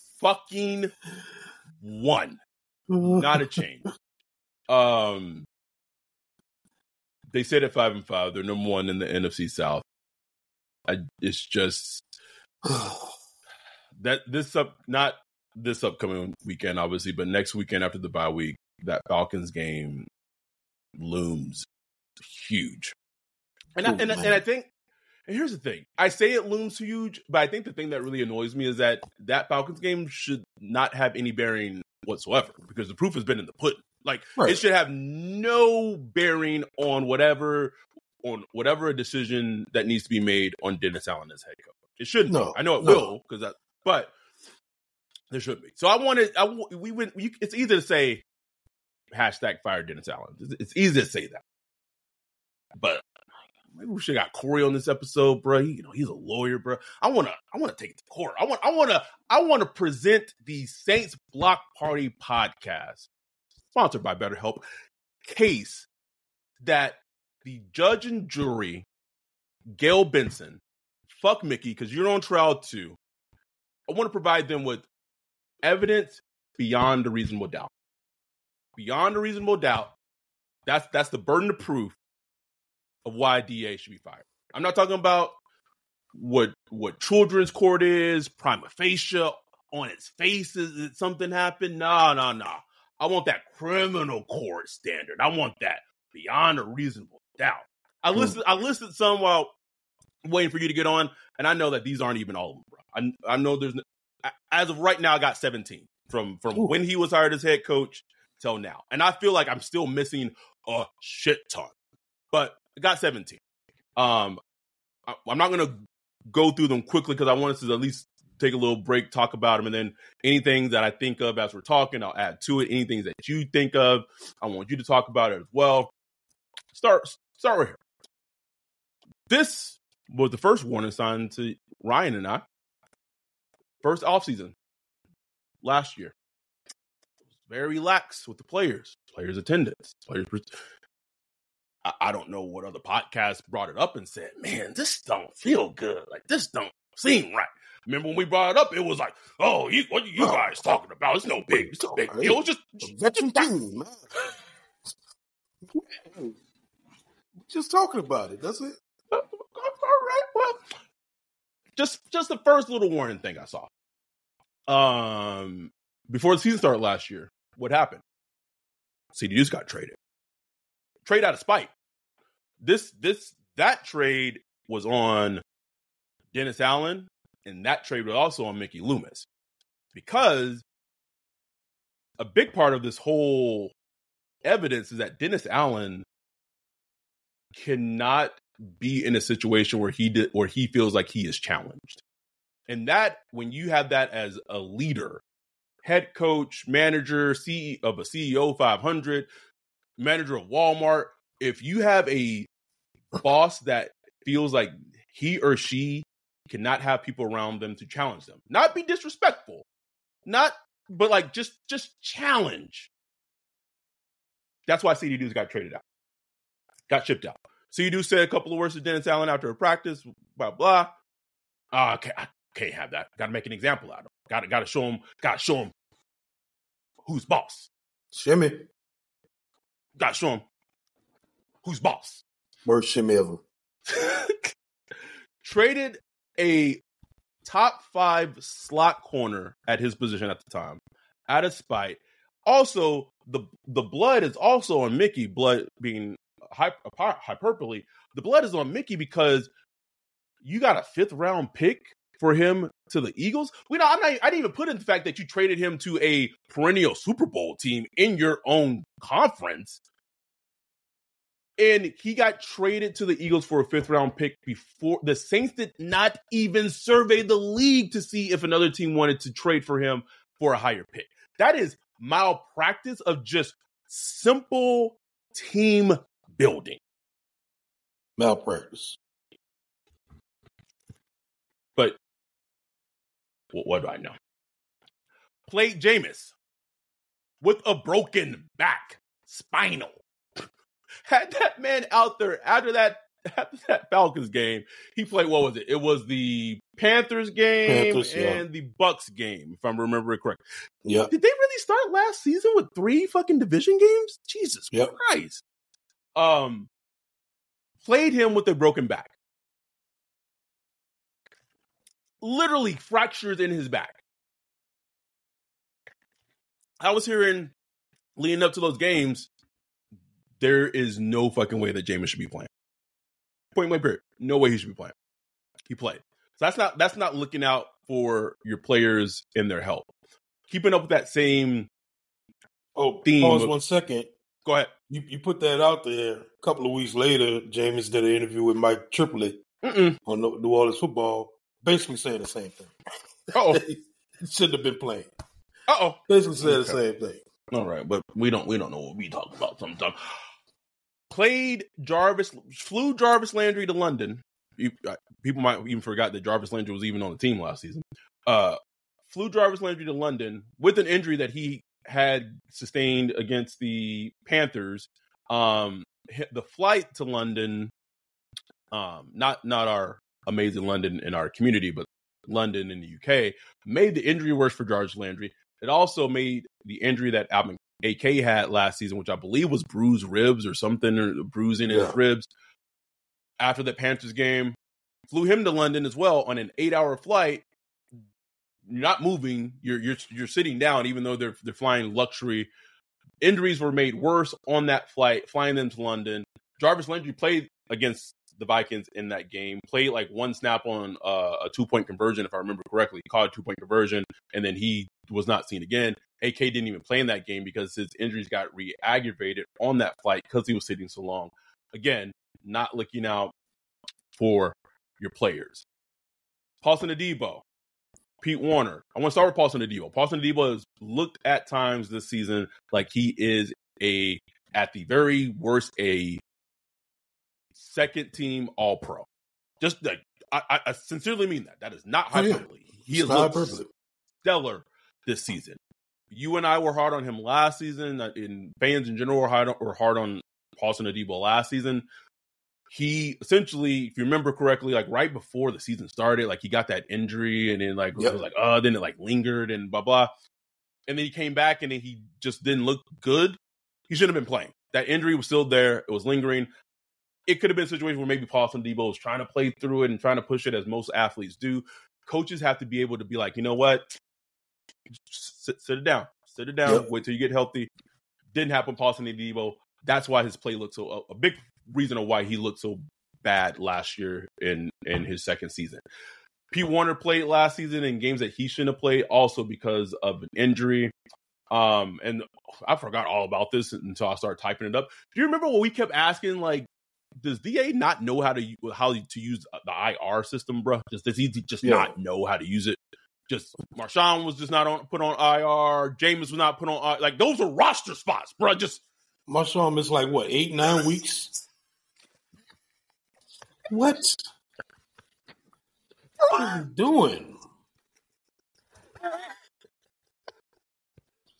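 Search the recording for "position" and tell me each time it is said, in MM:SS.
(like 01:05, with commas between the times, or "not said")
03:59.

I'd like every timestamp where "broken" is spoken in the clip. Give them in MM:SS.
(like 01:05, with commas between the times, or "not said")
04:47, 05:08.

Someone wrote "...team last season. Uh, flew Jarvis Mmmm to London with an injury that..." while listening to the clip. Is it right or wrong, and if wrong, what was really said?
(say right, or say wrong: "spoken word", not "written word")
wrong: "Landry", not "Mmmm".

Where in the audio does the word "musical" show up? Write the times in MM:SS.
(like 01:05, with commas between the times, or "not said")
not said.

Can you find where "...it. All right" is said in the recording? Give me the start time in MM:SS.
02:38.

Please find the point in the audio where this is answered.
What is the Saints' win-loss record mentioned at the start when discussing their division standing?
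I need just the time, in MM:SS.
00:07.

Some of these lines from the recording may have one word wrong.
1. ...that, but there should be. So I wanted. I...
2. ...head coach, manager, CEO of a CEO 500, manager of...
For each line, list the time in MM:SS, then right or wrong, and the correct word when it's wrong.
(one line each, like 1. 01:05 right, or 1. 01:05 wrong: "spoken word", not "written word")
1. 00:43 right
2. 03:15 right.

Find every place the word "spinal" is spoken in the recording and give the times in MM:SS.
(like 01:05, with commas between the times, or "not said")
04:49.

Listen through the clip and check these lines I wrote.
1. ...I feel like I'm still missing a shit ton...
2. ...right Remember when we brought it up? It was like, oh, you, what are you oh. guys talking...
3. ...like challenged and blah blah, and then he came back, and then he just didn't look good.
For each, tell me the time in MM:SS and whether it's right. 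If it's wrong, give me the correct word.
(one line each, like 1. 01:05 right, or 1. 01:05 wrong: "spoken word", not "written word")
1. 01:49 right
2. 02:27 right
3. 07:28 wrong: "lingered", not "challenged".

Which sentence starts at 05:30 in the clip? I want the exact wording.
Keeping up with that same oh theme.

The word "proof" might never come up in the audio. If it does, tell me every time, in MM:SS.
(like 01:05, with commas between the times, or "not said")
00:32, 01:21.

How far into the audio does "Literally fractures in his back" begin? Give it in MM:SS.
05:12.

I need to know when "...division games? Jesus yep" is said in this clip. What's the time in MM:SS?
05:03.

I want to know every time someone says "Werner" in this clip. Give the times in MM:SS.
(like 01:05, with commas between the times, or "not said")
06:58, 07:56.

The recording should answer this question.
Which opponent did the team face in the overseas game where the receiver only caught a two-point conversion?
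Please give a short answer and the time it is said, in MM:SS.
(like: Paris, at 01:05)
Vikings, at 06:38.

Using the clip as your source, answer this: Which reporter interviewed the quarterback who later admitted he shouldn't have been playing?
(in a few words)
Mike Triplett.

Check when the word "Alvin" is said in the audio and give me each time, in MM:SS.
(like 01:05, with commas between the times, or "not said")
06:17.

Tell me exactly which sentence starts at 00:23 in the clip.
And, Ooh, I, oh, and, I, and I think and here's the thing.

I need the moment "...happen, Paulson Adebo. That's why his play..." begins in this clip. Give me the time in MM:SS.
07:48.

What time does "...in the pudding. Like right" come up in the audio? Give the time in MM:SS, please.
00:33.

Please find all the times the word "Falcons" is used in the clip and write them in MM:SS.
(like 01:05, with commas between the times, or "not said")
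00:19, 00:29, 04:53.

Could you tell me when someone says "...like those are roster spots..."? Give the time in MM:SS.
08:17.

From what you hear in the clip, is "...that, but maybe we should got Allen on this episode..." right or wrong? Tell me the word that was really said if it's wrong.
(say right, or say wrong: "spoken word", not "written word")
wrong: "Corey", not "Allen".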